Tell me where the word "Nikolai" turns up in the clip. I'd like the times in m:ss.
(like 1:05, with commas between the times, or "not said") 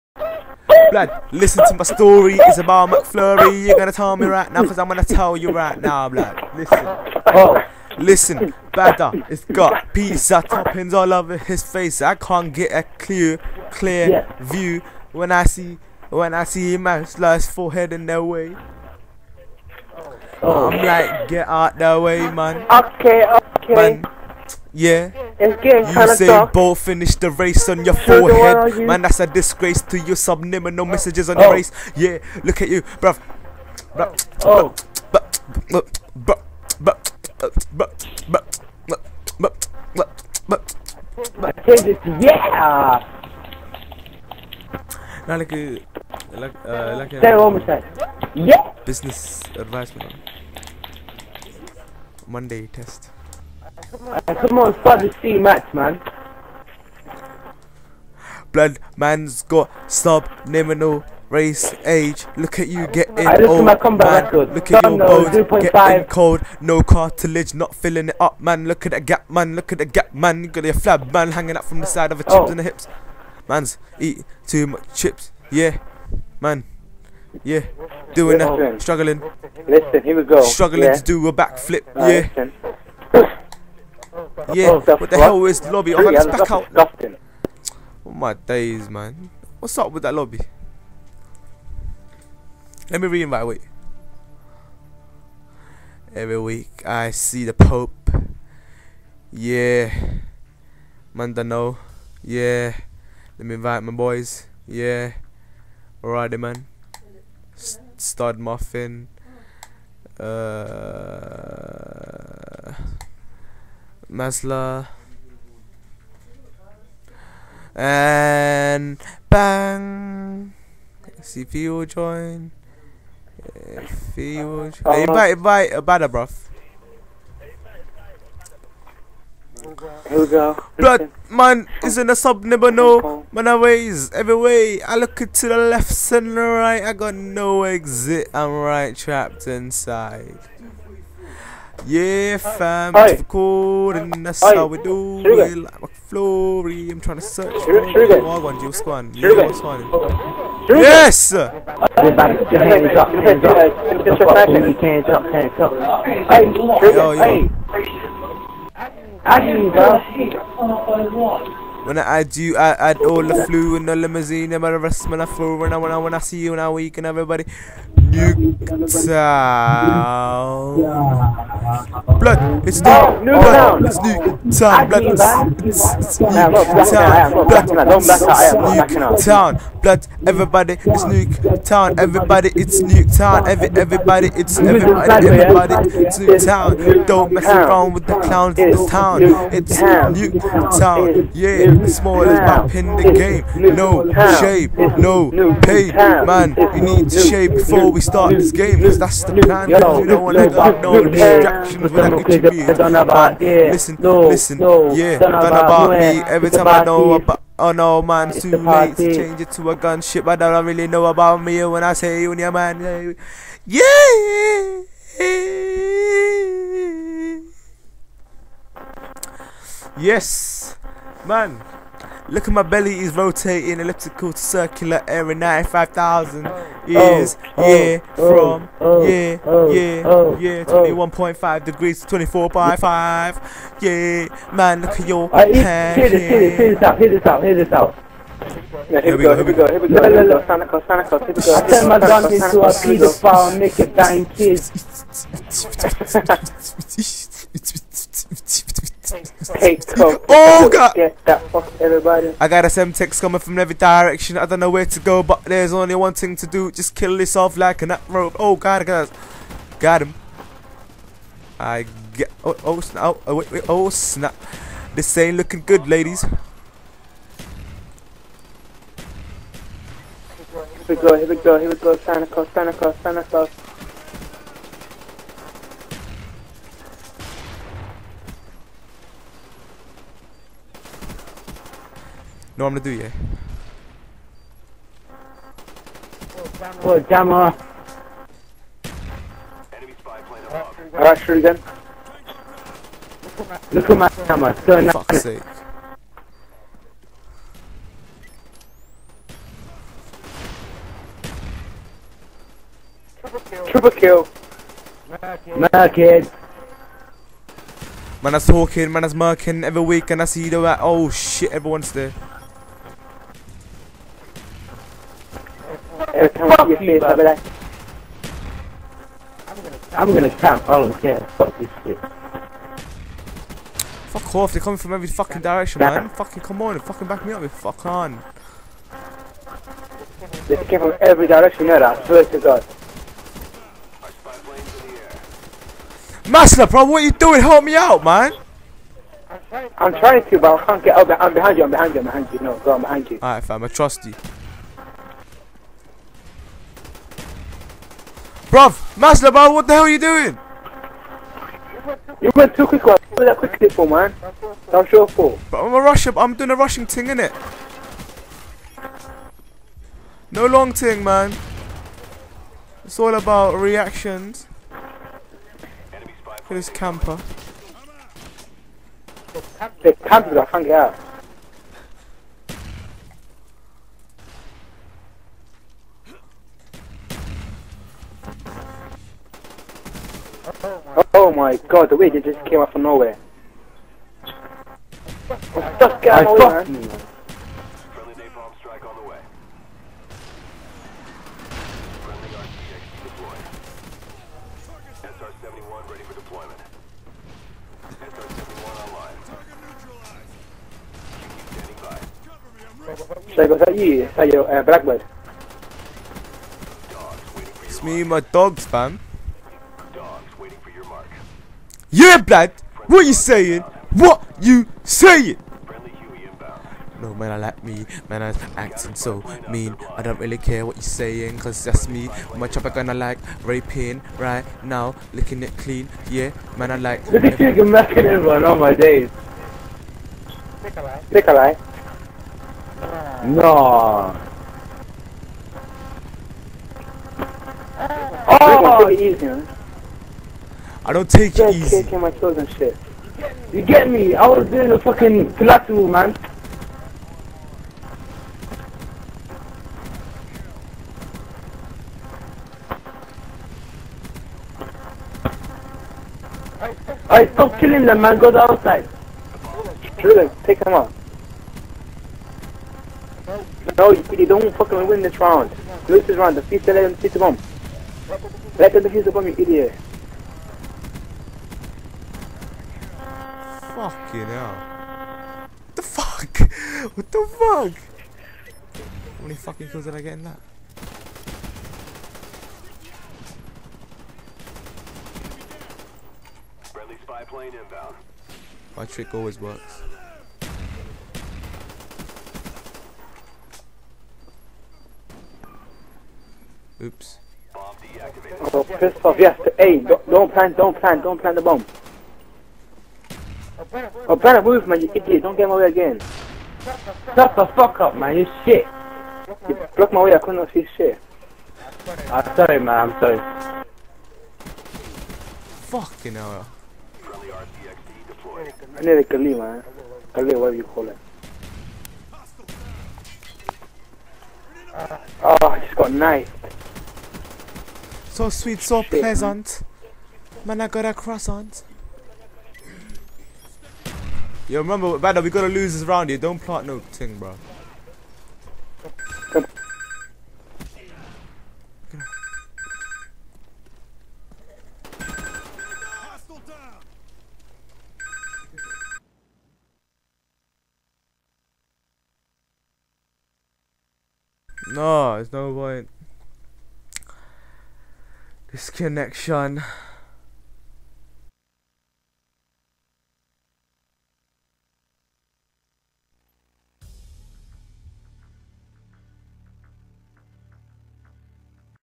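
7:11.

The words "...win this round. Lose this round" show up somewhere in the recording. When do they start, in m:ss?
7:44.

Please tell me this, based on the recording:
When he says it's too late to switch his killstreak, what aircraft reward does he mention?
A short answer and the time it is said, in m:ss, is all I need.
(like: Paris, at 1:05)
Gunship, at 3:29.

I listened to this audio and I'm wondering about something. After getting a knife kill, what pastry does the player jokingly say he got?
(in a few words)
A croissant.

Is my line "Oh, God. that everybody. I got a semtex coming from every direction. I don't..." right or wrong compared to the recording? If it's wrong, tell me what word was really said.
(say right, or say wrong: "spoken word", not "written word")
right.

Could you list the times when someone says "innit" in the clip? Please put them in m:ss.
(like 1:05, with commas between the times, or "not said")
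5:57.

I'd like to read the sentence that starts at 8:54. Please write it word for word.
Yo, remember, Bada, we gotta lose this round here.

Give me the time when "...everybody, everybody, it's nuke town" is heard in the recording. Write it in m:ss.
3:04.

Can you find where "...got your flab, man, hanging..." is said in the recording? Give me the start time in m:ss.
1:10.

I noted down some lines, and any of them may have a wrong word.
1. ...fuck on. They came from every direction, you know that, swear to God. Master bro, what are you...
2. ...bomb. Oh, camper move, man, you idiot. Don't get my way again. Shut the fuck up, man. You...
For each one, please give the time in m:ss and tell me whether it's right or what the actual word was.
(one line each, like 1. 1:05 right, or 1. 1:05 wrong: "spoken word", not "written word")
1. 5:27 right
2. 8:21 wrong: "better", not "camper".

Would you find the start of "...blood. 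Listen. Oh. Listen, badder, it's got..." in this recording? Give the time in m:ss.
0:06.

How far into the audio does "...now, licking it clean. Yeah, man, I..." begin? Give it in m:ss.
7:04.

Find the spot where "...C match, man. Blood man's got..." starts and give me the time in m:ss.
0:55.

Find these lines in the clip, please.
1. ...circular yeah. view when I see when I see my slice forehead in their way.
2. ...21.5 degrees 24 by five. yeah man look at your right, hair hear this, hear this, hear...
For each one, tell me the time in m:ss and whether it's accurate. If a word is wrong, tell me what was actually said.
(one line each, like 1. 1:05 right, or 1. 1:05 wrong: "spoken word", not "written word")
1. 0:13 wrong: "clear", not "circular"
2. 3:50 right.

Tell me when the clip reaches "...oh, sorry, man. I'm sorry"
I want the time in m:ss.
8:32.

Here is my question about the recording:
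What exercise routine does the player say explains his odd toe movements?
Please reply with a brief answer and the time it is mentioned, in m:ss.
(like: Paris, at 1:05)
Pilates, at 7:25.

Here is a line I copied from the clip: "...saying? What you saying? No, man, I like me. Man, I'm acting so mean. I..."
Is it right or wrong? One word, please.
right.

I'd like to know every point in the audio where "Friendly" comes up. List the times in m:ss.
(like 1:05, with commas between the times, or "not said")
8:06.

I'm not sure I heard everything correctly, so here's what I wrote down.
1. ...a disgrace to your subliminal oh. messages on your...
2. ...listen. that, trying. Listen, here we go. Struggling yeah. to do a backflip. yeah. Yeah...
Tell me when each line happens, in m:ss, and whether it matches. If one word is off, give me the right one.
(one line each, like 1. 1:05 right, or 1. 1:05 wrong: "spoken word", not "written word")
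1. 0:29 right
2. 1:18 wrong: "struggling", not "trying".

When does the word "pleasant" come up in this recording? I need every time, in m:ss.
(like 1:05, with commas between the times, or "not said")
8:48.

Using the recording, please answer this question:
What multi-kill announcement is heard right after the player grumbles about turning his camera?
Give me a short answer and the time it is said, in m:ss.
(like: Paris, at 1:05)
Triple kill, at 5:03.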